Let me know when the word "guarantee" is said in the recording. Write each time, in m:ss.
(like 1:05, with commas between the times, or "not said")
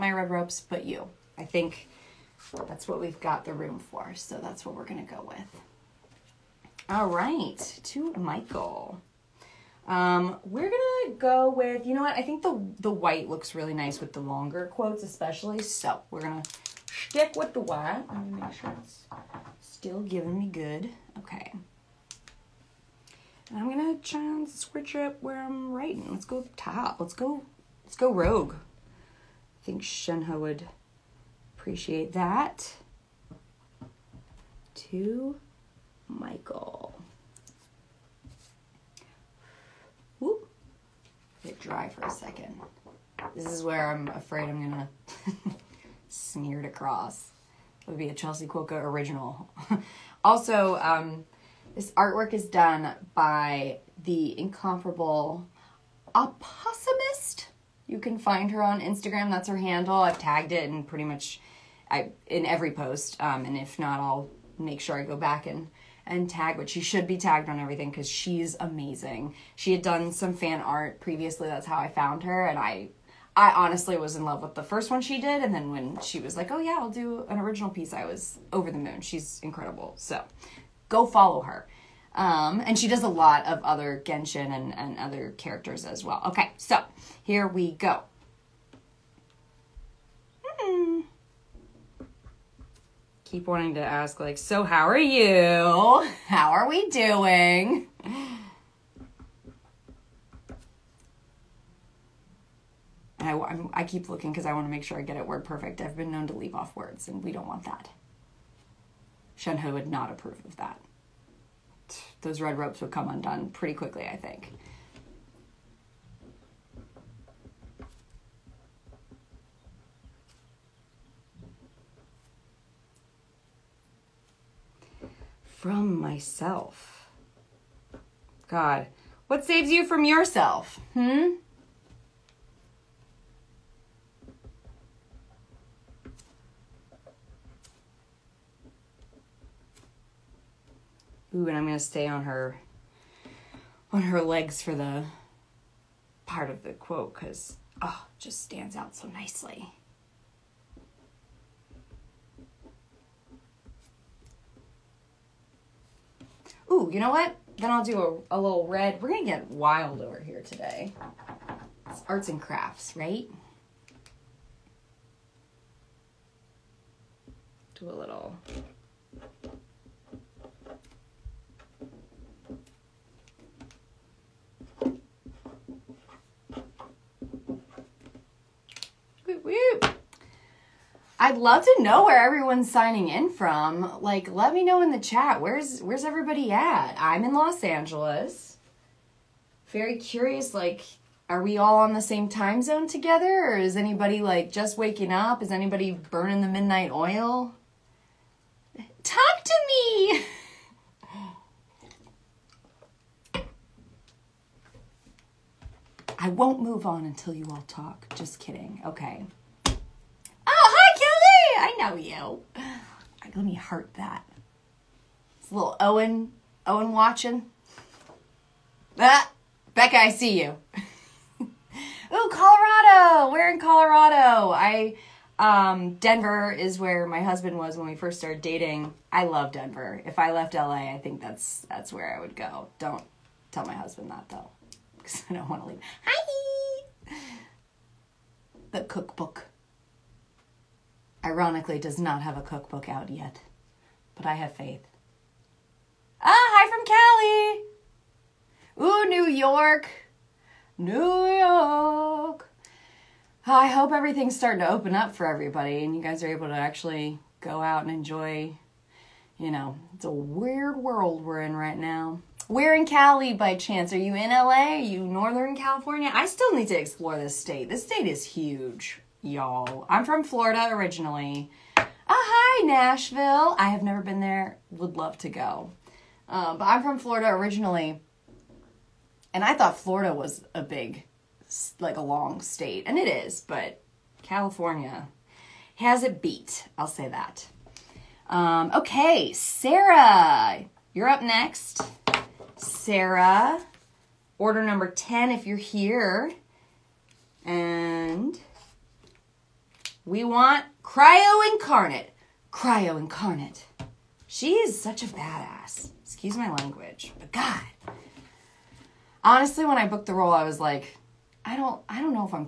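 not said.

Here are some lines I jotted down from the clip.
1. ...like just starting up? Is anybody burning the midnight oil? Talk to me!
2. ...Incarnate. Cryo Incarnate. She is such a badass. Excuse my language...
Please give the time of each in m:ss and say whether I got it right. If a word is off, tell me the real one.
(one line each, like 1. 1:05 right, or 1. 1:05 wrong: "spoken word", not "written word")
1. 3:14 wrong: "waking", not "starting"
2. 5:01 right.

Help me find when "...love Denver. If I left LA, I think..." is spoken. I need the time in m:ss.
3:49.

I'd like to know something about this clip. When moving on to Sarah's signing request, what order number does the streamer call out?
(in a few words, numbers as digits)
10.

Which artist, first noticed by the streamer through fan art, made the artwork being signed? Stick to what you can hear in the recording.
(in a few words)
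Opossumist.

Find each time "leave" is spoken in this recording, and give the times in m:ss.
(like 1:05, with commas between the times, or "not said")
1:46, 3:55.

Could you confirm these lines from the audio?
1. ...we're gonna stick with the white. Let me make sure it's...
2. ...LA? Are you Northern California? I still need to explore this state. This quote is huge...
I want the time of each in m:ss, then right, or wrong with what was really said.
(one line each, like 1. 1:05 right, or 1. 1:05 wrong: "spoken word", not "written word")
1. 0:16 right
2. 4:24 wrong: "state", not "quote".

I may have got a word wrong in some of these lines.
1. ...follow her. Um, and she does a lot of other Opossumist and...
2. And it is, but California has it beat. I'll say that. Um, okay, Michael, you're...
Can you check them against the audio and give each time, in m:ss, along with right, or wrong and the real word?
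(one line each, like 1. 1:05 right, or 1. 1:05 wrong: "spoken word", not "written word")
1. 1:21 wrong: "Genshin", not "Opossumist"
2. 4:42 wrong: "Sarah", not "Michael".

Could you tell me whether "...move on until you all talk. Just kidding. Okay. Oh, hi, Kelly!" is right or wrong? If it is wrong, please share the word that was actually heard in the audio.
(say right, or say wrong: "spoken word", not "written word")
right.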